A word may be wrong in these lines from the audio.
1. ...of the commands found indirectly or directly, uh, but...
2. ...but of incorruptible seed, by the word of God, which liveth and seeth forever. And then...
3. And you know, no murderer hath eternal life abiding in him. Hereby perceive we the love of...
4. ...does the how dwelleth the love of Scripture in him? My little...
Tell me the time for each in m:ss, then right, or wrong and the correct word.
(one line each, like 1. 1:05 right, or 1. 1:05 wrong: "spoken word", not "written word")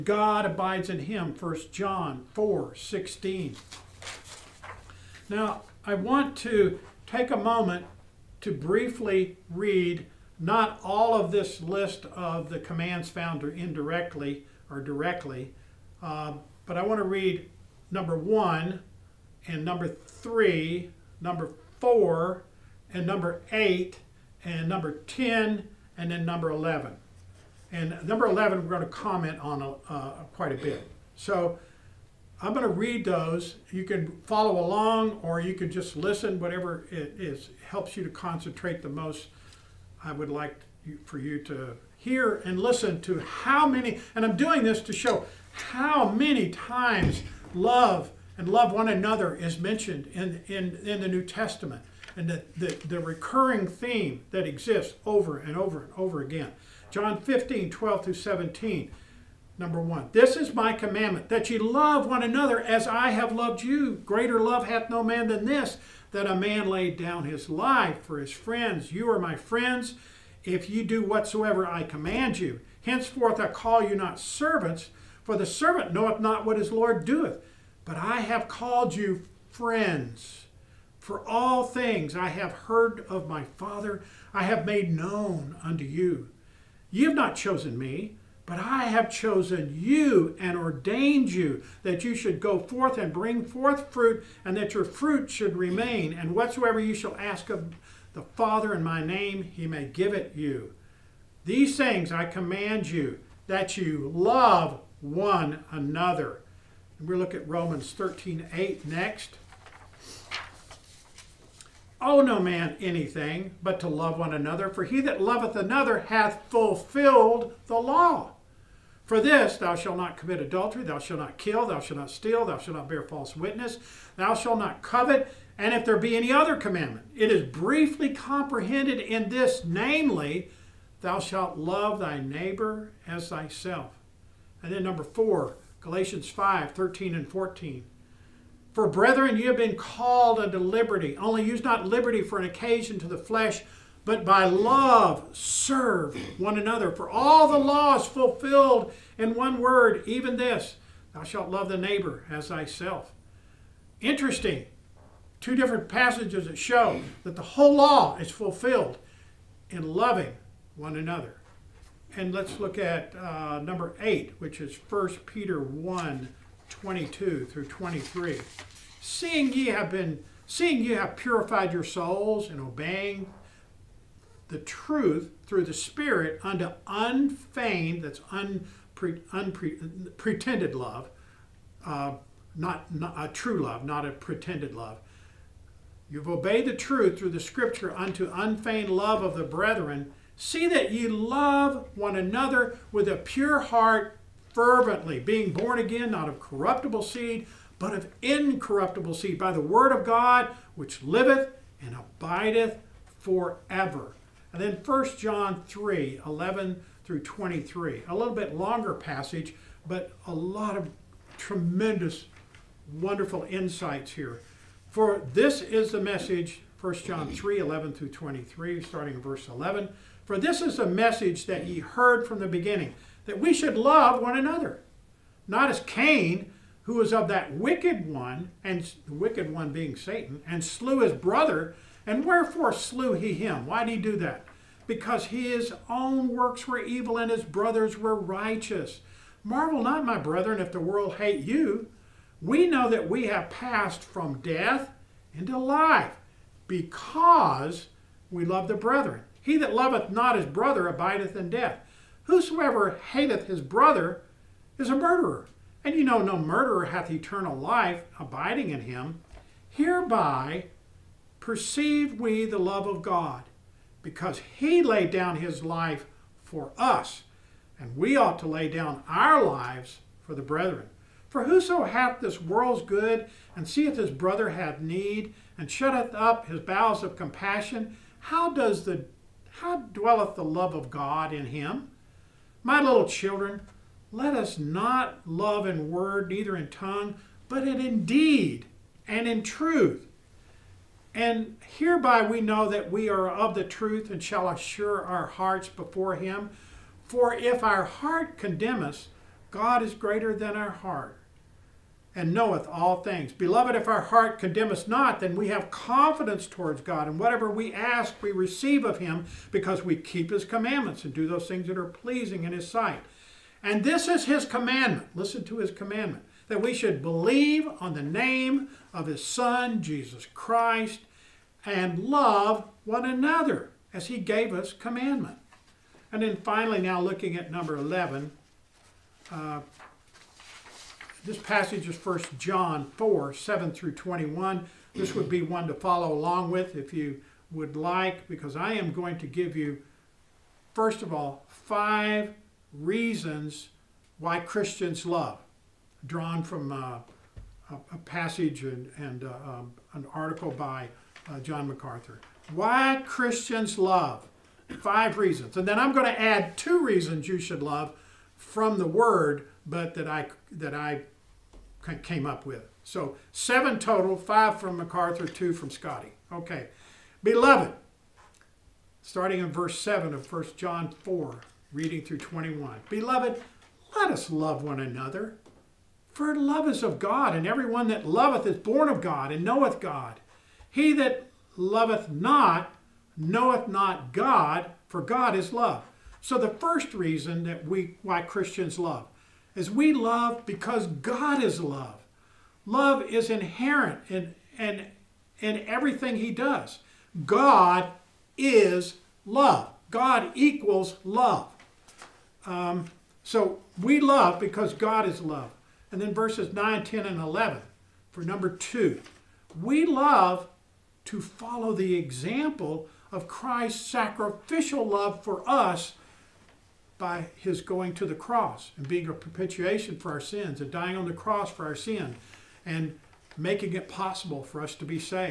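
1. 0:12 right
2. 3:17 wrong: "abideth", not "seeth"
3. 4:15 right
4. 4:38 wrong: "God", not "Scripture".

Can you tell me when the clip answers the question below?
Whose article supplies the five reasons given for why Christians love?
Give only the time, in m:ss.
5:51.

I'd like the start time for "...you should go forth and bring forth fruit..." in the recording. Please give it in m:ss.
1:32.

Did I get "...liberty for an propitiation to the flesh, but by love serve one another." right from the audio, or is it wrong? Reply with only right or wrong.
wrong.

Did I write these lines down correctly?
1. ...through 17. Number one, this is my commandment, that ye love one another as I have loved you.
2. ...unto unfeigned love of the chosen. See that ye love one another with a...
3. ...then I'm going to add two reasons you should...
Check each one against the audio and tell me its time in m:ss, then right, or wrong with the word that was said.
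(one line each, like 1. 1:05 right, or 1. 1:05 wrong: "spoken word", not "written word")
1. 0:58 right
2. 3:07 wrong: "brethren", not "chosen"
3. 5:55 right.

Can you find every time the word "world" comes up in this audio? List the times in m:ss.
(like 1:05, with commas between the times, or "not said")
4:00, 4:32.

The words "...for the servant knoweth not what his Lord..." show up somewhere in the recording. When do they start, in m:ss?
1:15.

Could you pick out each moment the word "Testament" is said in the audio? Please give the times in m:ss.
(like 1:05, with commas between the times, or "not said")
0:51.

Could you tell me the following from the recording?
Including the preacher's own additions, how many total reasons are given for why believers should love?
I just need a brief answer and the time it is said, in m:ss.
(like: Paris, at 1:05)
7, at 6:03.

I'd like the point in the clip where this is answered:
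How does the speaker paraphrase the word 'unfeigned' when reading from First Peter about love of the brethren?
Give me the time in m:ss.
3:03.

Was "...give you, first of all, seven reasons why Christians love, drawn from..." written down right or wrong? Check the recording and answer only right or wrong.
wrong.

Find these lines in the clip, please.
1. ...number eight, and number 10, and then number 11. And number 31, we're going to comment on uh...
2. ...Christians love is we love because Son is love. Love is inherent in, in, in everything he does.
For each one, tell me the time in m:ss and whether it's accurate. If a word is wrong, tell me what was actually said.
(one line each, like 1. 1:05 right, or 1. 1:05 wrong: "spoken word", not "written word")
1. 0:23 wrong: "11", not "31"
2. 6:28 wrong: "God", not "Son".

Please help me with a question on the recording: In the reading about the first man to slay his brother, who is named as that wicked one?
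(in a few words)
Satan.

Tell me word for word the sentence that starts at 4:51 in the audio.
And hereby we know that we are of the truth and shall assure our hearts before him.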